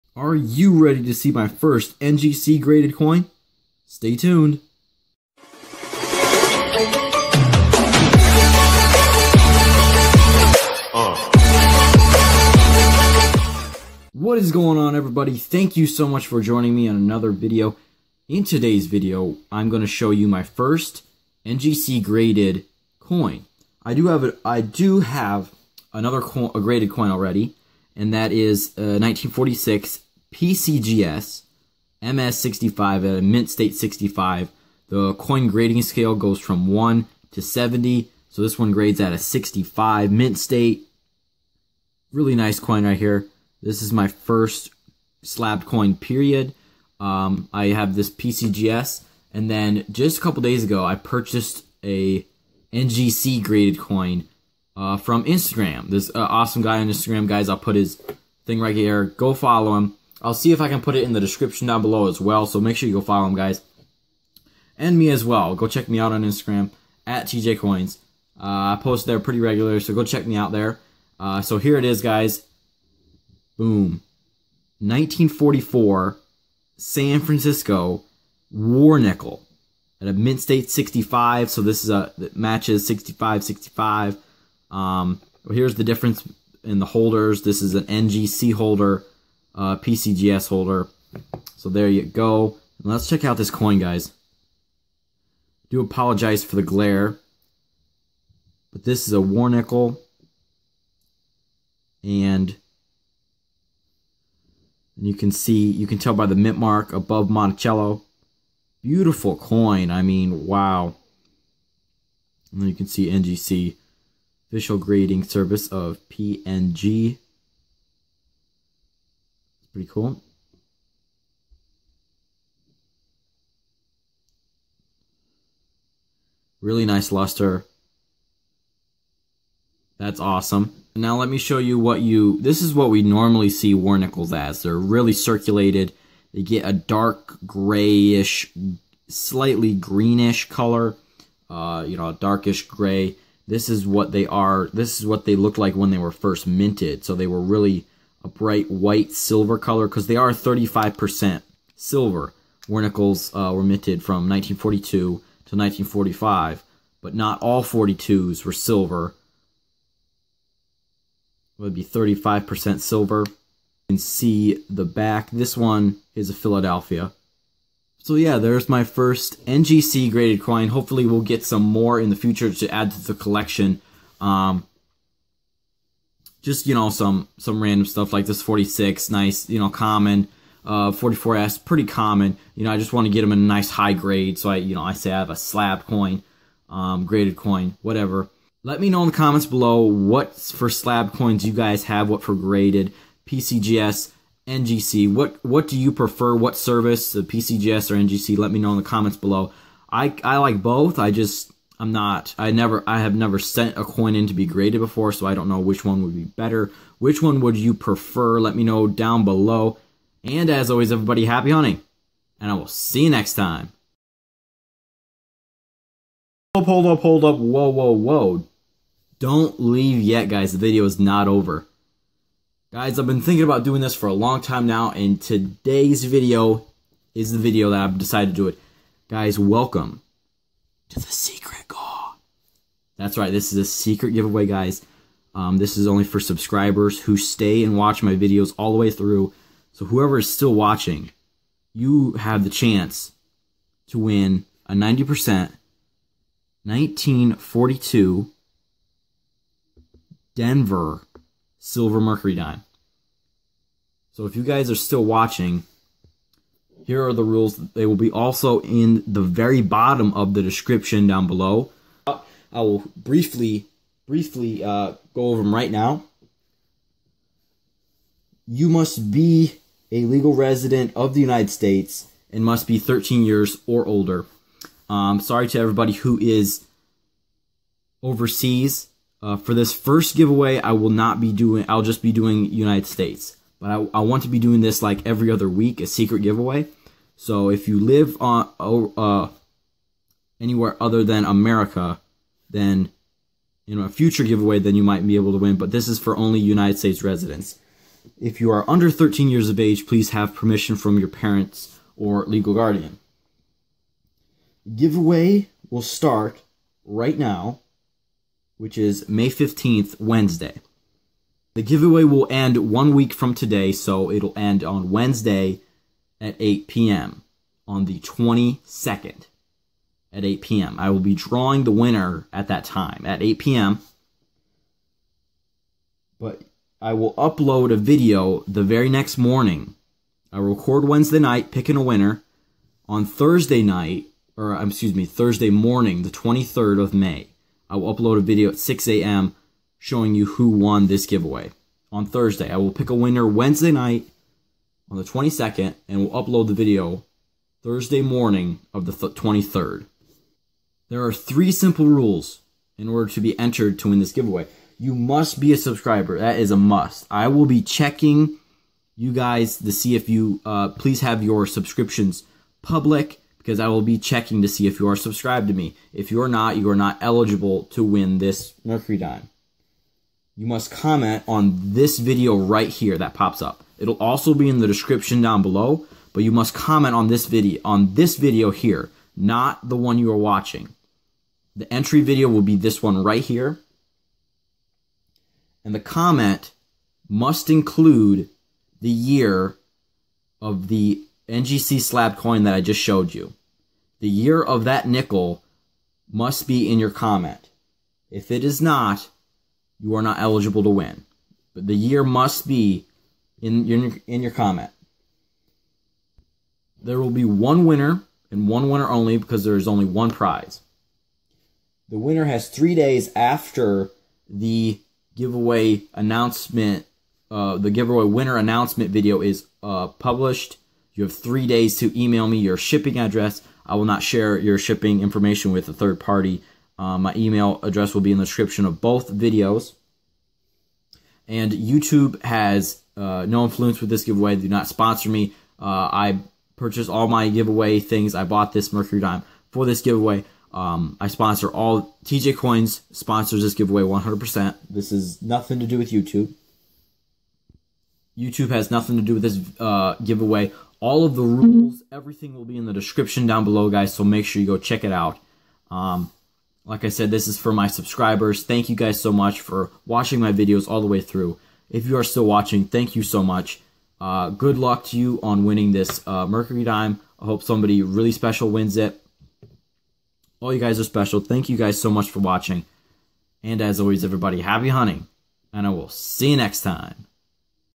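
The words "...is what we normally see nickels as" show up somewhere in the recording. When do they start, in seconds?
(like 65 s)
132 s.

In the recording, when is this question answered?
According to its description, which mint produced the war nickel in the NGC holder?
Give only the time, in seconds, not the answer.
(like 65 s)
76 s.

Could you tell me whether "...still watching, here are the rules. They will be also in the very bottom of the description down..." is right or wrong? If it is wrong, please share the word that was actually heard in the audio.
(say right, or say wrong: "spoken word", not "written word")
right.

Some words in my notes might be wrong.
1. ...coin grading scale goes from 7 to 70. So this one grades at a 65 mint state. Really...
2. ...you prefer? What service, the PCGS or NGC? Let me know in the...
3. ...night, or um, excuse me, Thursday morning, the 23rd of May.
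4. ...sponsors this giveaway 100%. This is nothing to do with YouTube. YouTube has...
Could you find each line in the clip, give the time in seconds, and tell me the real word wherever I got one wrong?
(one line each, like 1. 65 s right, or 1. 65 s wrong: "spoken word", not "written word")
1. 35 s wrong: "1", not "7"
2. 195 s right
3. 333 s right
4. 442 s right.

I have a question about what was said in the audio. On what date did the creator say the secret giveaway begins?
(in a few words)
May 15th.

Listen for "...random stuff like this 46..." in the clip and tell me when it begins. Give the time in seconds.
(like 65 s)
177 s.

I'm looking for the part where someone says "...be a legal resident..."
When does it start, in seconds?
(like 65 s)
269 s.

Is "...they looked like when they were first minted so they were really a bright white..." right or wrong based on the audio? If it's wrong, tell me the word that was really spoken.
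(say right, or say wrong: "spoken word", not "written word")
right.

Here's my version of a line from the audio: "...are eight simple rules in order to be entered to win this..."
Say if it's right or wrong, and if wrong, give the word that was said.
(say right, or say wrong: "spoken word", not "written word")
wrong: "three", not "eight".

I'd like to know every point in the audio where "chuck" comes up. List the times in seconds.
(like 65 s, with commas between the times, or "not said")
not said.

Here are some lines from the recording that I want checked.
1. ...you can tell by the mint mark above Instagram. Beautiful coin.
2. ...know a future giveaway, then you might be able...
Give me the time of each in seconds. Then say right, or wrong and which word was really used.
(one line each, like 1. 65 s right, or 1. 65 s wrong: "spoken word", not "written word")
1. 105 s wrong: "Monticello", not "Instagram"
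2. 293 s right.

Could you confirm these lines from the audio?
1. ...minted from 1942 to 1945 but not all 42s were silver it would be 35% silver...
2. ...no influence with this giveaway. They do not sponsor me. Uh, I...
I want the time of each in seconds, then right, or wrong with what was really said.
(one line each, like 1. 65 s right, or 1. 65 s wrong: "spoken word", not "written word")
1. 153 s right
2. 433 s right.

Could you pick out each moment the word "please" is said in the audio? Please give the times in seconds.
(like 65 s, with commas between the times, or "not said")
299 s, 360 s.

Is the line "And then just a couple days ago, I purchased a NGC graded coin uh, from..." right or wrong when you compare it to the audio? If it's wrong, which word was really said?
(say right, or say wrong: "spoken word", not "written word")
right.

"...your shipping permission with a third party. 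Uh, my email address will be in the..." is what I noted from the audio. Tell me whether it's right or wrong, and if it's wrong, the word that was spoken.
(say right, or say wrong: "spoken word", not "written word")
wrong: "information", not "permission".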